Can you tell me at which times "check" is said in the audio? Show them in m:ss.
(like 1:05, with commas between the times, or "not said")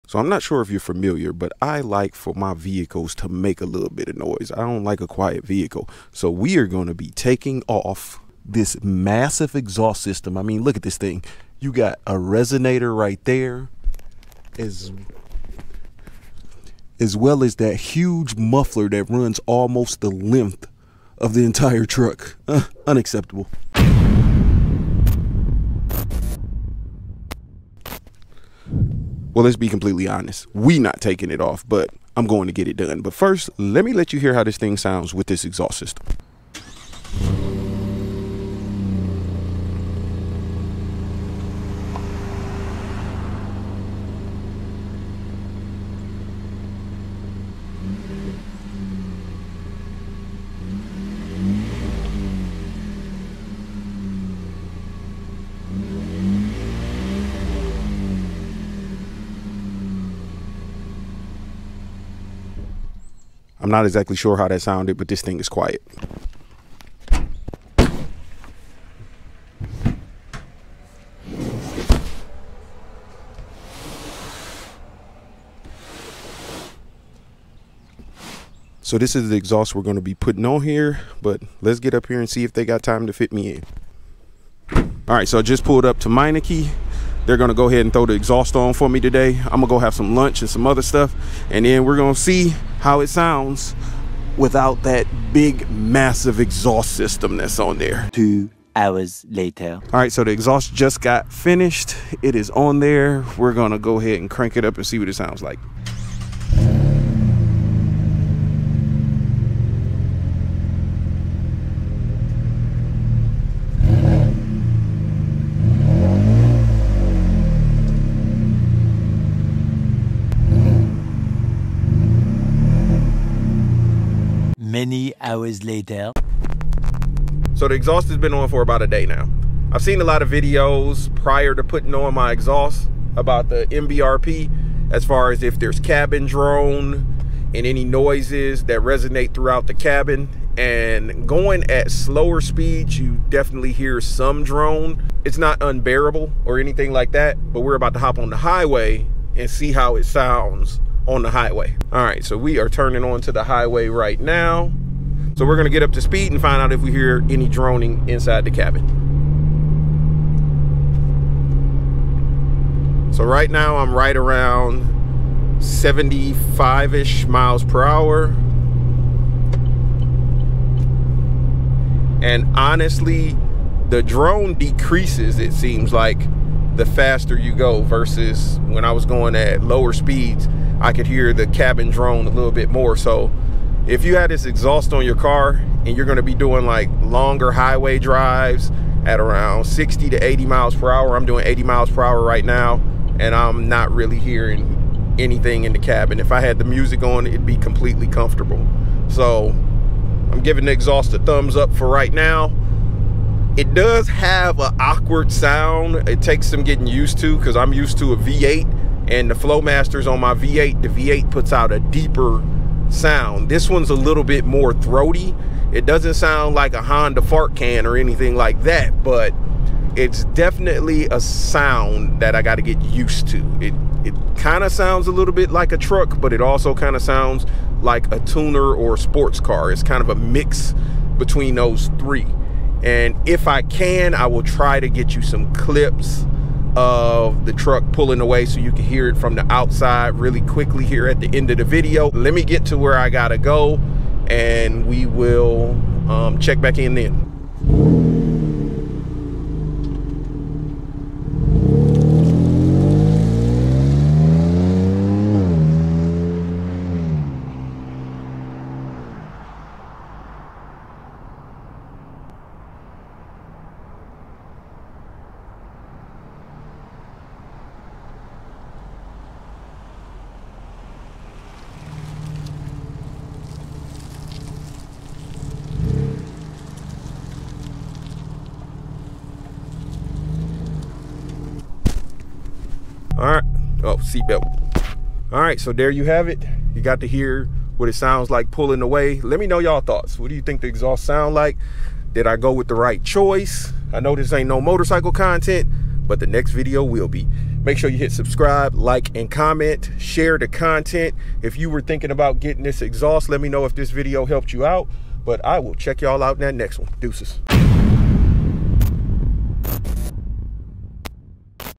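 4:06, 5:05.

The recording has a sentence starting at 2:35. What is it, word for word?
So we're gonna get up to speed and find out if we hear any droning inside the cabin.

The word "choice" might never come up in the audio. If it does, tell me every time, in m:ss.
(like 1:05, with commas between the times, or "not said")
4:53.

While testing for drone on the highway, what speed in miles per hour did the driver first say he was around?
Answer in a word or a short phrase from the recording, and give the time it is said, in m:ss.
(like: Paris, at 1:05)
75, at 2:45.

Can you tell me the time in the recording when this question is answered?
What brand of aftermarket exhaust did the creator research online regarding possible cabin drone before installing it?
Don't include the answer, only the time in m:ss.
2:13.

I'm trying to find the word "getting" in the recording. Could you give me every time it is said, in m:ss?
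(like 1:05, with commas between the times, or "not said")
3:26, 5:02.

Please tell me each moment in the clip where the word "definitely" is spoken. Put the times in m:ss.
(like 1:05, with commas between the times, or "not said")
2:23, 3:40.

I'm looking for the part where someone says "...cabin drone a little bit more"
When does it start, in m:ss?
3:01.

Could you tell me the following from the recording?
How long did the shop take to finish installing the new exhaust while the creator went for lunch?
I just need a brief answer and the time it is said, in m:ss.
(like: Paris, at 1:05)
2 hours, at 1:38.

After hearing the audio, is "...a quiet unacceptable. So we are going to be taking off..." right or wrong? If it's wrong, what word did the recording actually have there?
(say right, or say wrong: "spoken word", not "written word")
wrong: "vehicle", not "unacceptable".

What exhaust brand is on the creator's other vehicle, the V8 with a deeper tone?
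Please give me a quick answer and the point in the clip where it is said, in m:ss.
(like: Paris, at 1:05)
Flowmasters, at 3:29.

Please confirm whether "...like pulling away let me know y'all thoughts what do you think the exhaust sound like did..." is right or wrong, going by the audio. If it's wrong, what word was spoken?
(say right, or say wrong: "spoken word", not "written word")
right.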